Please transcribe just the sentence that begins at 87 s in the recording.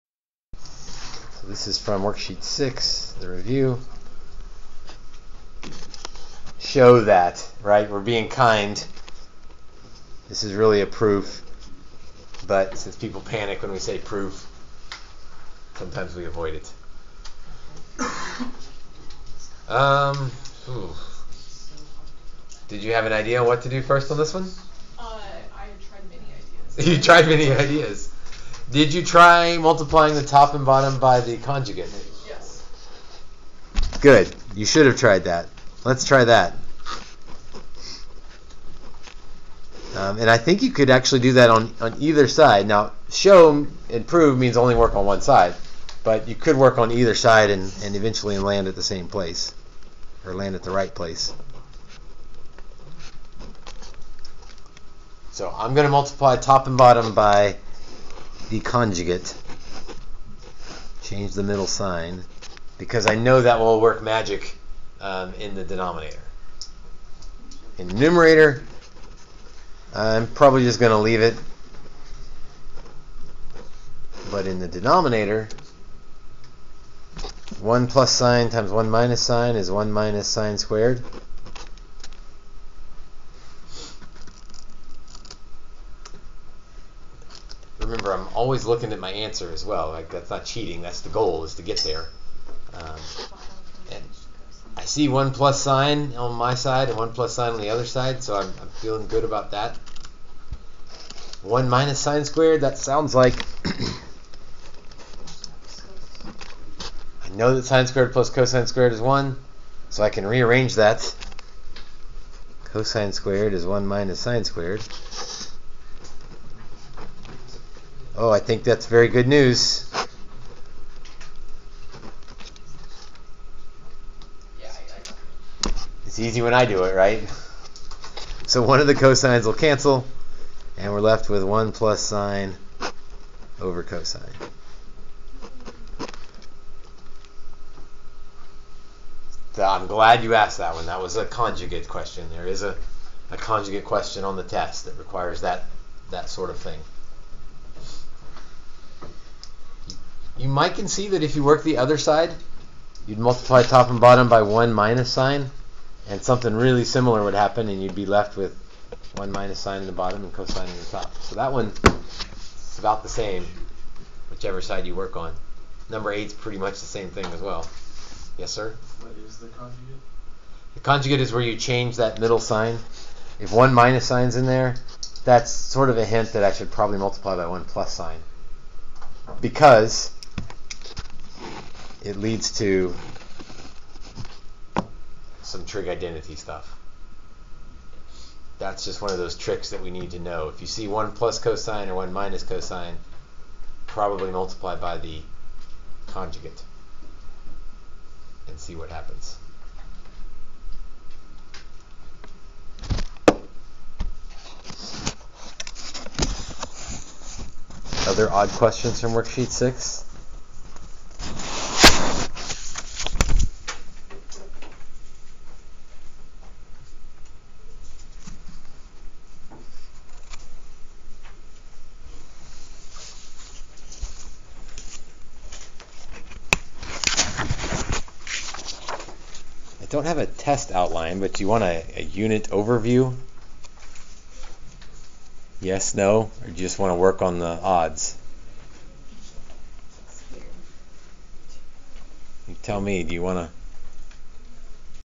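remember, I'm always looking at my answer as well.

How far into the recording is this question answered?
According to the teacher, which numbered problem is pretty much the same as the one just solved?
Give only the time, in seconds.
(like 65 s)
165 s.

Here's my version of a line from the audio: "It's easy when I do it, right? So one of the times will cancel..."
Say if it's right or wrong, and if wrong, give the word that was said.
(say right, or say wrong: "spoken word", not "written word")
wrong: "cosines", not "times".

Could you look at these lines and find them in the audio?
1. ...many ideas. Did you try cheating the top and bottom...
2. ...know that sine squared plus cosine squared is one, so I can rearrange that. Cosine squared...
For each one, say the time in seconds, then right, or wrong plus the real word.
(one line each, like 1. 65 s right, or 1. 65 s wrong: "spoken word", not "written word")
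1. 27 s wrong: "multiplying", not "cheating"
2. 107 s right.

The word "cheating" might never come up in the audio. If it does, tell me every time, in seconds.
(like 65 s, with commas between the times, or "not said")
90 s.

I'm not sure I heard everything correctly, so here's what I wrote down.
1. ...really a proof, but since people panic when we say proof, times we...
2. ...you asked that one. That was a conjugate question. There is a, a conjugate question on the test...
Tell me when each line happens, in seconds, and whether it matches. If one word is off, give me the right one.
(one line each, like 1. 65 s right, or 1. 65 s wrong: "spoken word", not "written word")
1. 10 s wrong: "sometimes", not "times"
2. 140 s right.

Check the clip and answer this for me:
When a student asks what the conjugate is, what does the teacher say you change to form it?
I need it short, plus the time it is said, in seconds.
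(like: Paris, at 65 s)
The middle sign, at 171 s.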